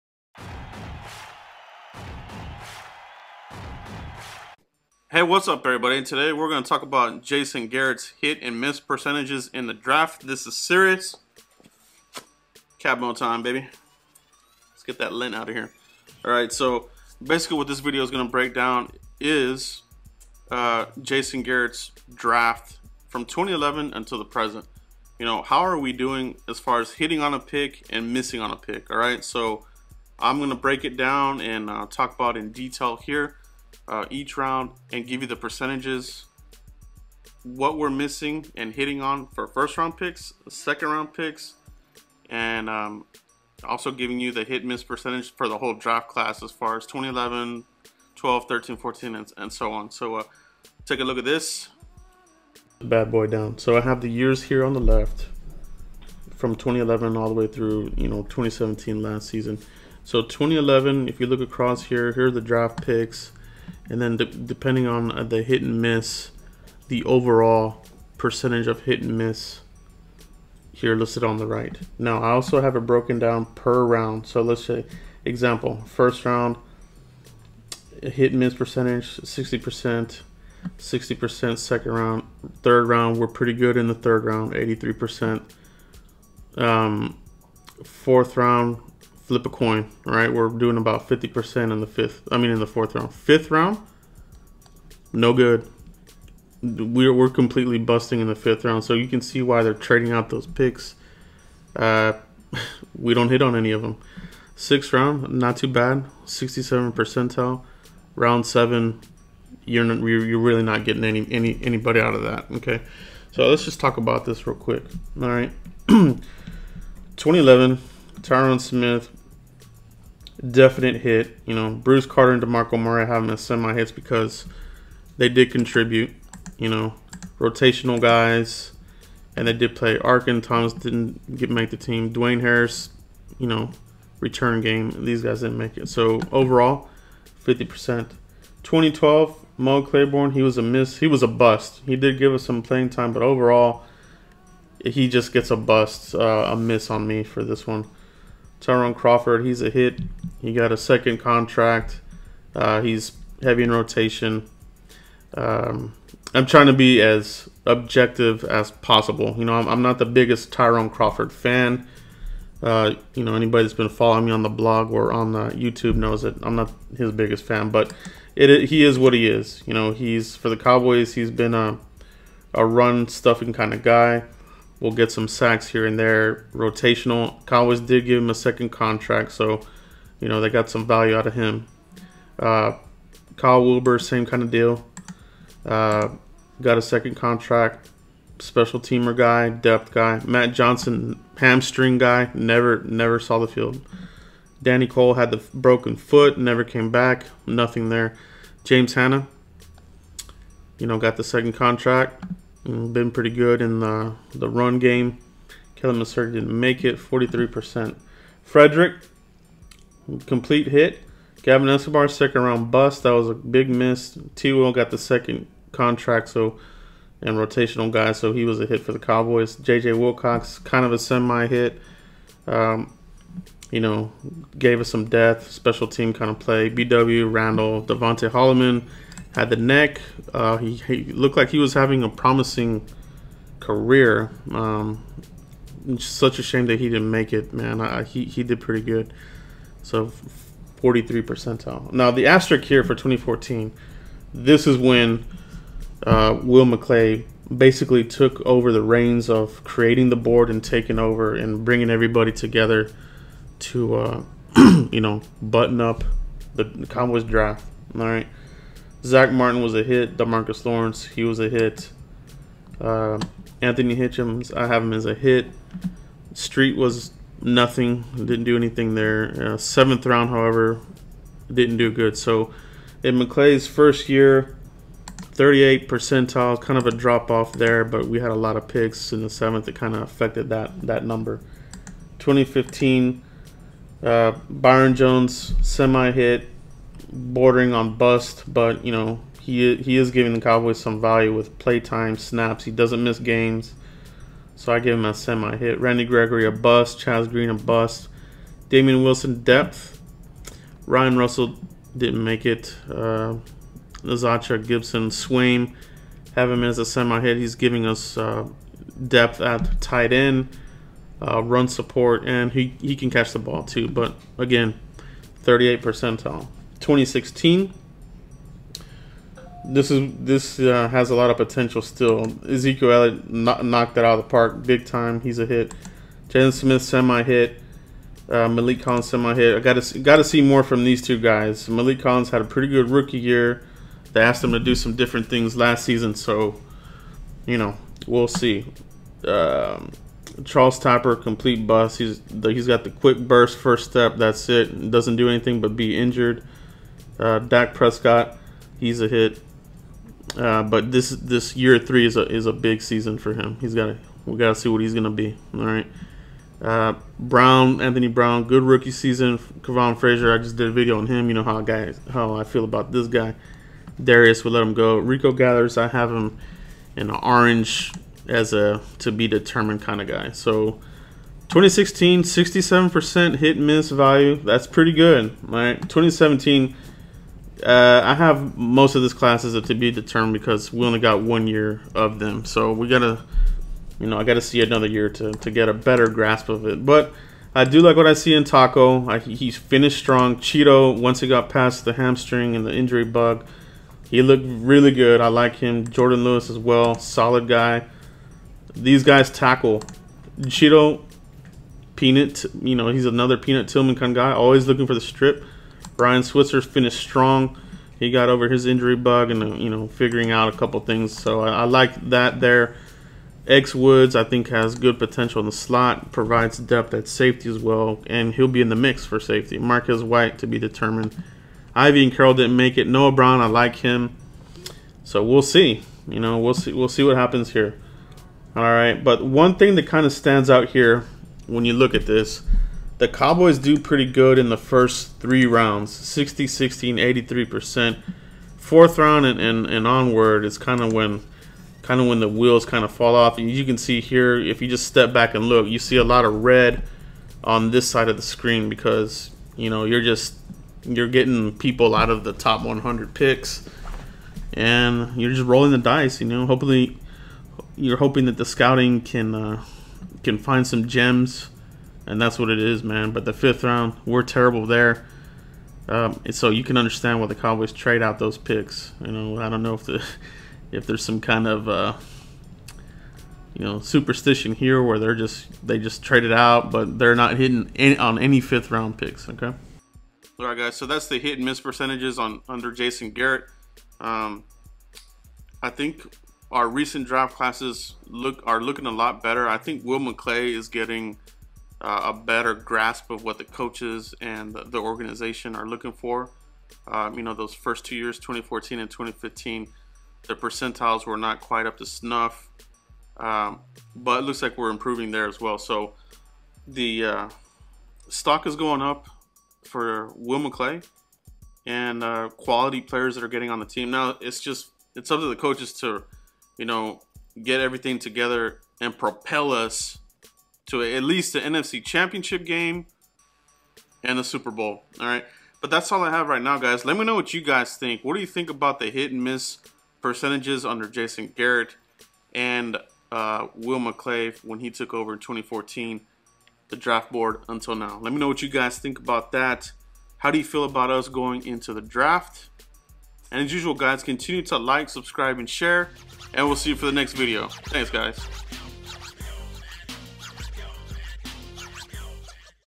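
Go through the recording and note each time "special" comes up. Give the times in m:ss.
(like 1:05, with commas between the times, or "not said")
3:08, 3:45.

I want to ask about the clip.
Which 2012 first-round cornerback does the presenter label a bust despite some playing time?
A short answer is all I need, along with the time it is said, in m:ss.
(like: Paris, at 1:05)
Mo Claiborne, at 2:19.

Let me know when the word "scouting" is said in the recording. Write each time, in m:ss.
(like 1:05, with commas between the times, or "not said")
7:38.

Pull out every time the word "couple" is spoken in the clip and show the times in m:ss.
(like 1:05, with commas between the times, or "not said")
6:50.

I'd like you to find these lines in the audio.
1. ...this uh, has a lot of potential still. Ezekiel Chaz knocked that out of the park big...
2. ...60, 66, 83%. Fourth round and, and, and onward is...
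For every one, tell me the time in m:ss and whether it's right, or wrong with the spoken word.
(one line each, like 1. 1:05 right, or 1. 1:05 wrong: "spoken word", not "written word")
1. 5:20 wrong: "Elliott", not "Chaz"
2. 7:15 wrong: "16", not "66".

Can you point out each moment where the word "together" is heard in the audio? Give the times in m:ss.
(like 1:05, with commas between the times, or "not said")
4:12, 8:37.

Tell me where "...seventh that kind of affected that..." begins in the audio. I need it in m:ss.
4:39.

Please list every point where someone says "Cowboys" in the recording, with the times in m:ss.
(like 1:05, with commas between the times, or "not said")
2:50, 2:57, 3:38, 4:16, 4:50, 7:13, 7:47.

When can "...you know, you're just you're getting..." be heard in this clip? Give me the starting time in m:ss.
7:29.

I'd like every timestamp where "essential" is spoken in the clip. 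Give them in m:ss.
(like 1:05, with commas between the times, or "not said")
not said.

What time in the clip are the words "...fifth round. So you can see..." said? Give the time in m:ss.
1:38.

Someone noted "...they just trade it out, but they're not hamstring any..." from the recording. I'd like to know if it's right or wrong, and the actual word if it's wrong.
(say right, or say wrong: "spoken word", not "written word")
wrong: "hitting", not "hamstring".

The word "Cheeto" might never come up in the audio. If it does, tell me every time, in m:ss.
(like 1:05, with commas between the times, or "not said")
6:30, 6:40.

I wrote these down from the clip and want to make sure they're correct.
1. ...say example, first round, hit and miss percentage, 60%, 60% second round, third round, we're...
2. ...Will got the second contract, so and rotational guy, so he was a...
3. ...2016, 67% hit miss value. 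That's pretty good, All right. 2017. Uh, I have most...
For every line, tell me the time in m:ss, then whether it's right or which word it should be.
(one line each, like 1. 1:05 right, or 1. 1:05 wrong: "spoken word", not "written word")
1. 1:14 right
2. 3:34 right
3. 6:11 right.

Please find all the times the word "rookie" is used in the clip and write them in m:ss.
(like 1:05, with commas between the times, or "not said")
5:32, 5:58.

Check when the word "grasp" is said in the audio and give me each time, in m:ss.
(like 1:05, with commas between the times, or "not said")
6:26, 8:12.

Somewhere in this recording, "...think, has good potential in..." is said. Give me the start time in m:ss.
6:54.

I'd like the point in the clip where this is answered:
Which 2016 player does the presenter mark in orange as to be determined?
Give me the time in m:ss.
6:04.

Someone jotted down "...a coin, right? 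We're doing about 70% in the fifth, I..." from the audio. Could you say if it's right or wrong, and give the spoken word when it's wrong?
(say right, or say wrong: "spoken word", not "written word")
wrong: "50", not "70".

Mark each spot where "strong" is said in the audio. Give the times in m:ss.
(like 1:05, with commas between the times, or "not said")
6:29, 6:46.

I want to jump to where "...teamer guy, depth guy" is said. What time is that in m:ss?
3:08.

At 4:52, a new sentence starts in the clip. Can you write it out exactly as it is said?
He doesn't miss games, so I give him a semi hit.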